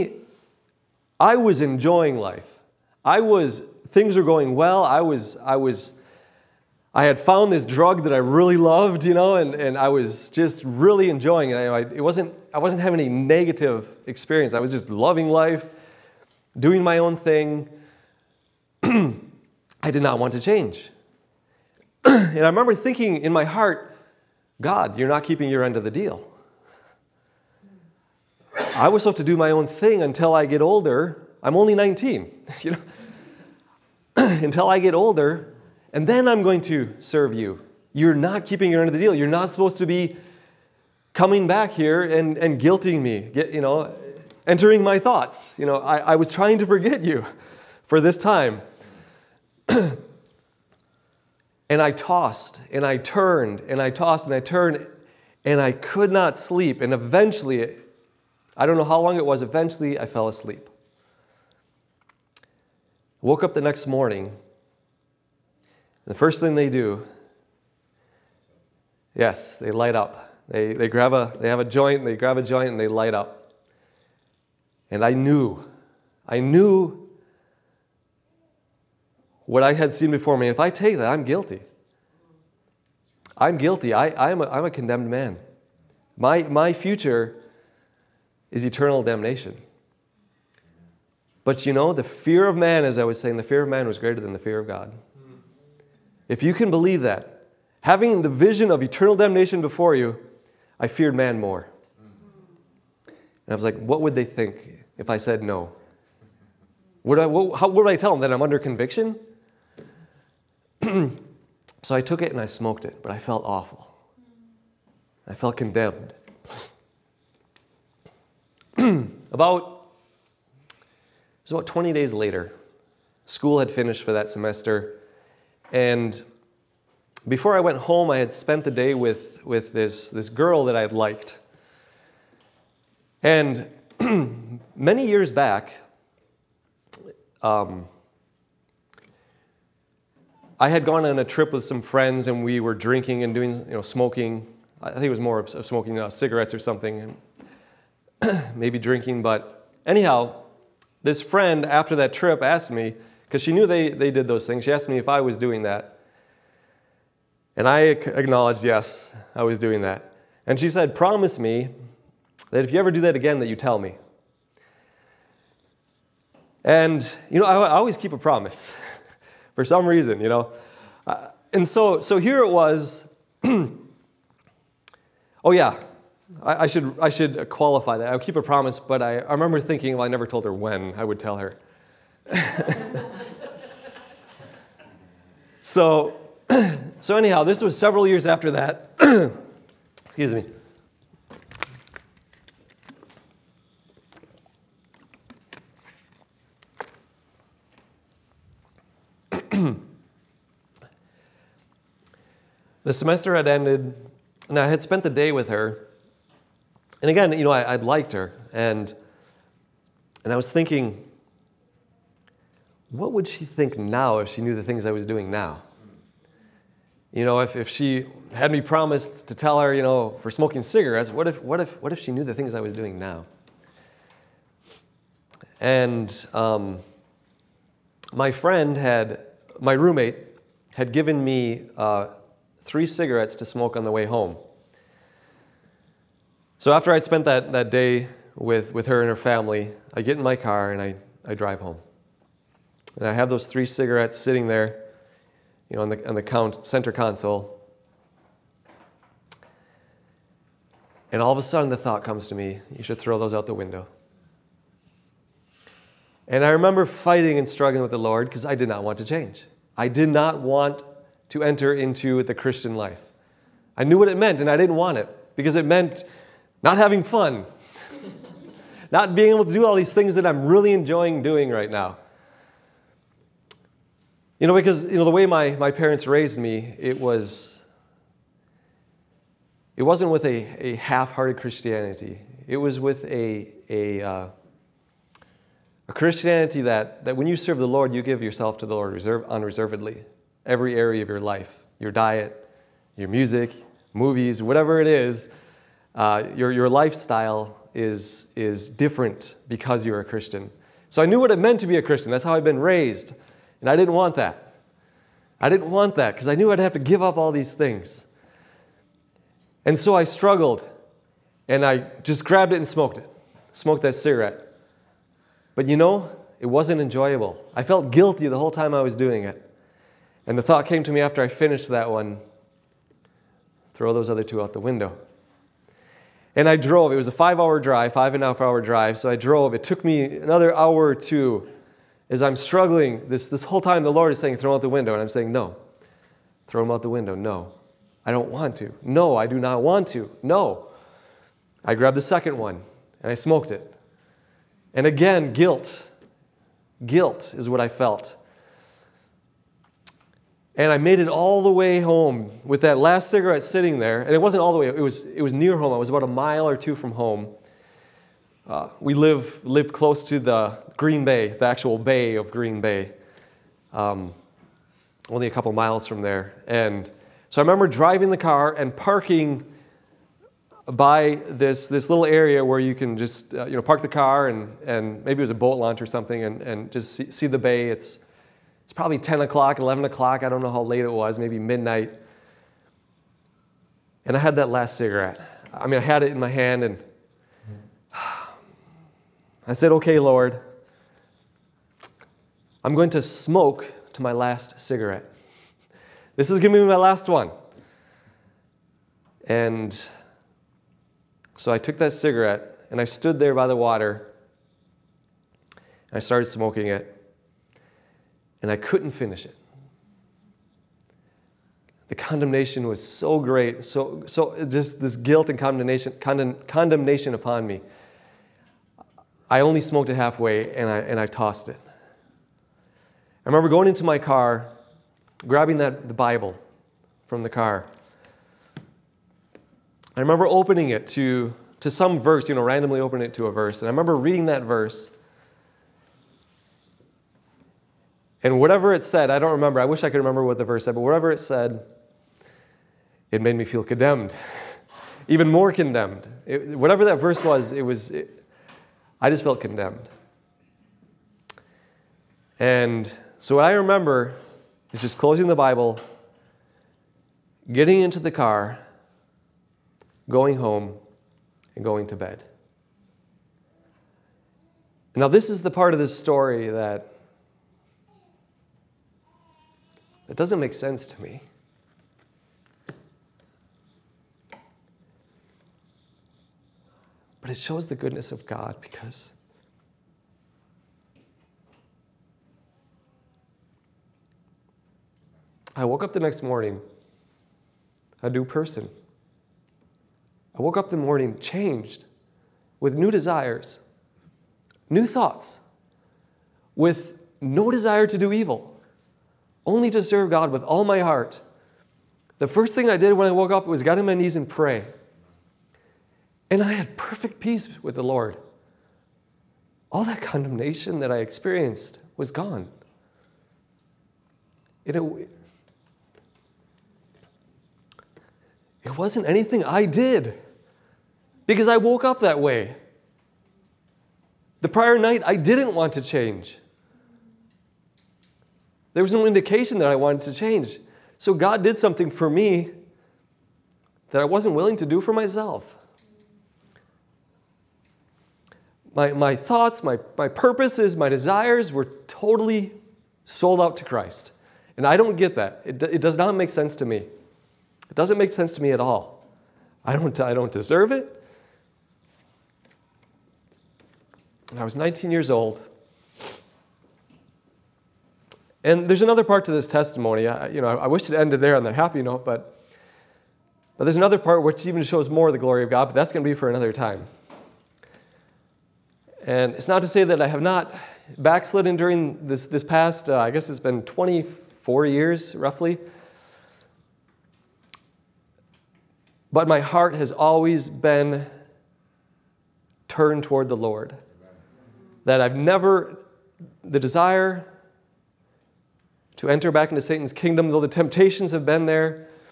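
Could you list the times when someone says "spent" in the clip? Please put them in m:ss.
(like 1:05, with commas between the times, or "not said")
2:08, 3:24, 3:57.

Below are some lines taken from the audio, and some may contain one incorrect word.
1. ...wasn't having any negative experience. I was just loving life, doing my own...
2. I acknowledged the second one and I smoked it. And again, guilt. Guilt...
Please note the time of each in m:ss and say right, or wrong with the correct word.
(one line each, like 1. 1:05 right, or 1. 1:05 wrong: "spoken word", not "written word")
1. 0:12 right
2. 5:41 wrong: "grabbed", not "acknowledged".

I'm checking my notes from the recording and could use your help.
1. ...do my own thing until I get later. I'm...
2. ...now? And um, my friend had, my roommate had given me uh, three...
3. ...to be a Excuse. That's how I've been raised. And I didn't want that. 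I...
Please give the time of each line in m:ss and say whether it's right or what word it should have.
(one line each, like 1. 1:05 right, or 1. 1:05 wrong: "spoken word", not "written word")
1. 0:29 wrong: "older", not "later"
2. 3:42 right
3. 5:01 wrong: "Christian", not "Excuse".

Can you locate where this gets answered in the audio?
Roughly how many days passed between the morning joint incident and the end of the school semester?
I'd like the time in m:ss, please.
2:01.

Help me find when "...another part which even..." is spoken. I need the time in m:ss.
9:23.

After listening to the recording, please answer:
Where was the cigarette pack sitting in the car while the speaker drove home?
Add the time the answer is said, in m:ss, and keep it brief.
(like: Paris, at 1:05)
center console, at 4:06.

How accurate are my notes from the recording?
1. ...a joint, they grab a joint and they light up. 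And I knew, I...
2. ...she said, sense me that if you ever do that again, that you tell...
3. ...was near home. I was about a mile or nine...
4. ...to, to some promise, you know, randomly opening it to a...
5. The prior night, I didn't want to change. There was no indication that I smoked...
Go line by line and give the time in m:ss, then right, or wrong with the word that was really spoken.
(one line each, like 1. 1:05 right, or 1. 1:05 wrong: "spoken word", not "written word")
1. 1:11 right
2. 2:40 wrong: "promise", not "sense"
3. 5:55 wrong: "two", not "nine"
4. 7:10 wrong: "verse", not "promise"
5. 8:44 wrong: "wanted", not "smoked".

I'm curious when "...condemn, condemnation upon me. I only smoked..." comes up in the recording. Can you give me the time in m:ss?
6:55.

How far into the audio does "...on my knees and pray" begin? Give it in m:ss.
8:23.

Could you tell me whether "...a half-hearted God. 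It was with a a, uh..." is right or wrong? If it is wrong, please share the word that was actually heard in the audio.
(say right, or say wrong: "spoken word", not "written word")
wrong: "Christianity", not "God".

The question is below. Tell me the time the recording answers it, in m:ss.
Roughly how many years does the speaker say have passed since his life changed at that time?
9:33.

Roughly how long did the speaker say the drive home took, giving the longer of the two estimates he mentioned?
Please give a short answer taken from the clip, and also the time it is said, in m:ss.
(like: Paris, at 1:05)
5 and a half hours, at 5:27.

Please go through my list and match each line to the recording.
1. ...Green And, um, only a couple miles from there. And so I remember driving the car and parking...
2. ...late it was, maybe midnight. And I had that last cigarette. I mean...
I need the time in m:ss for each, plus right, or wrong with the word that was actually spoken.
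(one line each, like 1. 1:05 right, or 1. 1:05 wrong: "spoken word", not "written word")
1. 6:02 wrong: "Bay", not "And"
2. 6:20 right.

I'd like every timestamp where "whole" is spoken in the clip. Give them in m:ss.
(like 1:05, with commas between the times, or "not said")
5:18, 5:33.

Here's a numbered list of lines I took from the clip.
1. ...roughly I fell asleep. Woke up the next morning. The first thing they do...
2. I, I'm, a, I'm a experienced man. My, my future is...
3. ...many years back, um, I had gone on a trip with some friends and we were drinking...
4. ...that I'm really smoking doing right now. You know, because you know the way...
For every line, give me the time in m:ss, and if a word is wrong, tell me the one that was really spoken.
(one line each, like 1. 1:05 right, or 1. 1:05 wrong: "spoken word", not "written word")
1. 0:59 wrong: "eventually", not "roughly"
2. 1:23 wrong: "condemned", not "experienced"
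3. 2:14 right
4. 4:30 wrong: "enjoying", not "smoking".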